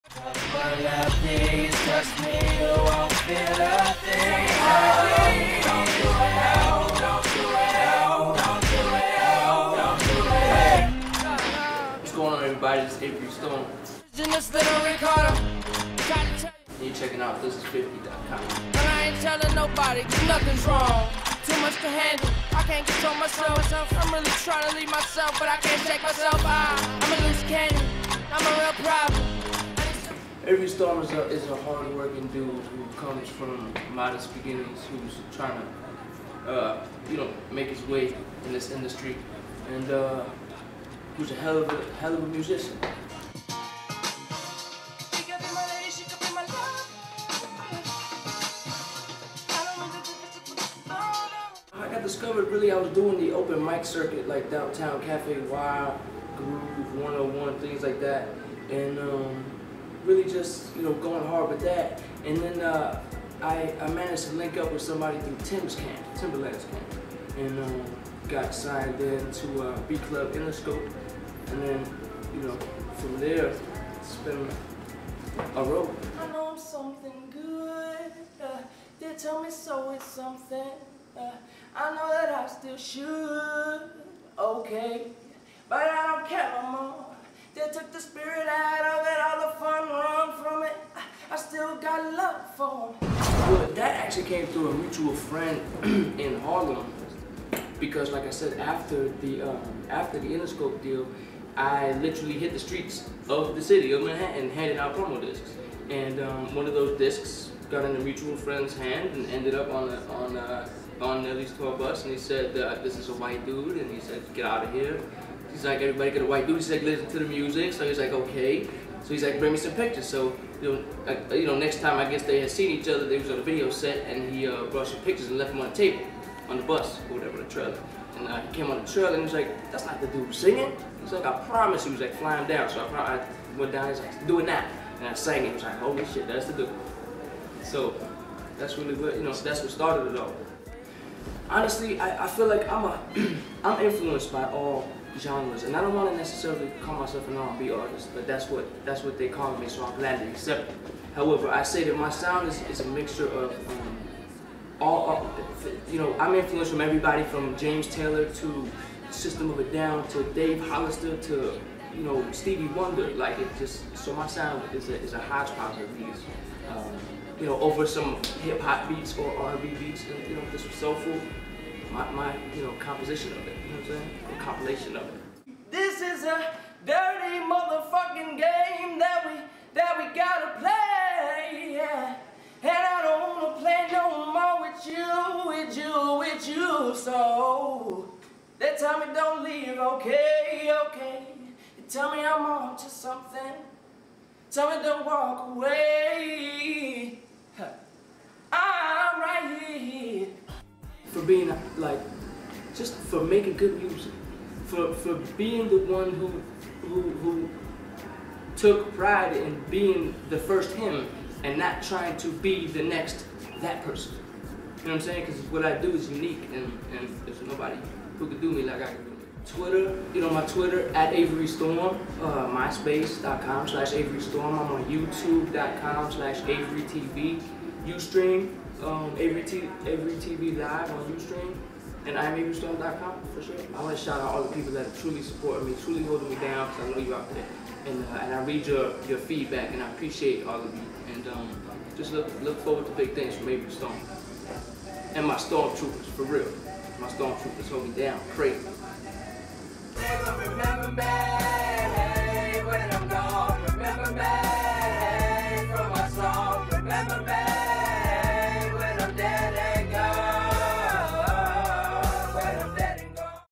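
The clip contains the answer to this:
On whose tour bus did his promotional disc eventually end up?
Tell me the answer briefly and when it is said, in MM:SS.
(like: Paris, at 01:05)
Nelly, at 01:51.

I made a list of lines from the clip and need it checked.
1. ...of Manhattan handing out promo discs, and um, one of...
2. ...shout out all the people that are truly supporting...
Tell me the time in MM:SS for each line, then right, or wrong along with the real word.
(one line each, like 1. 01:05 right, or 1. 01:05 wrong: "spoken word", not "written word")
1. 01:43 right
2. 03:54 right.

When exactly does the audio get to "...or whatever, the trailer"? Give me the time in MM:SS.
02:07.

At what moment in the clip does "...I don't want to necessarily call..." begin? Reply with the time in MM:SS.
02:25.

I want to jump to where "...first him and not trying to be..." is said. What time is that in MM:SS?
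03:30.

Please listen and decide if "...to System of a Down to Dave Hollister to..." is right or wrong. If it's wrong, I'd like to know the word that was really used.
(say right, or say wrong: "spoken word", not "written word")
right.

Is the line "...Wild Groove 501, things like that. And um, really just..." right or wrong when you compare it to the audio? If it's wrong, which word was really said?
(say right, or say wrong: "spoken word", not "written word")
wrong: "101", not "501".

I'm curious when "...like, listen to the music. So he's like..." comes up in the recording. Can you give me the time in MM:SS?
01:56.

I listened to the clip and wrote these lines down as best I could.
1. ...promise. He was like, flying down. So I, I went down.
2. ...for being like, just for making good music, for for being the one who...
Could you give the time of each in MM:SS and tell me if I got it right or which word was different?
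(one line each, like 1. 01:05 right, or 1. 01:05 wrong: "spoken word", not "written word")
1. 02:11 right
2. 03:21 right.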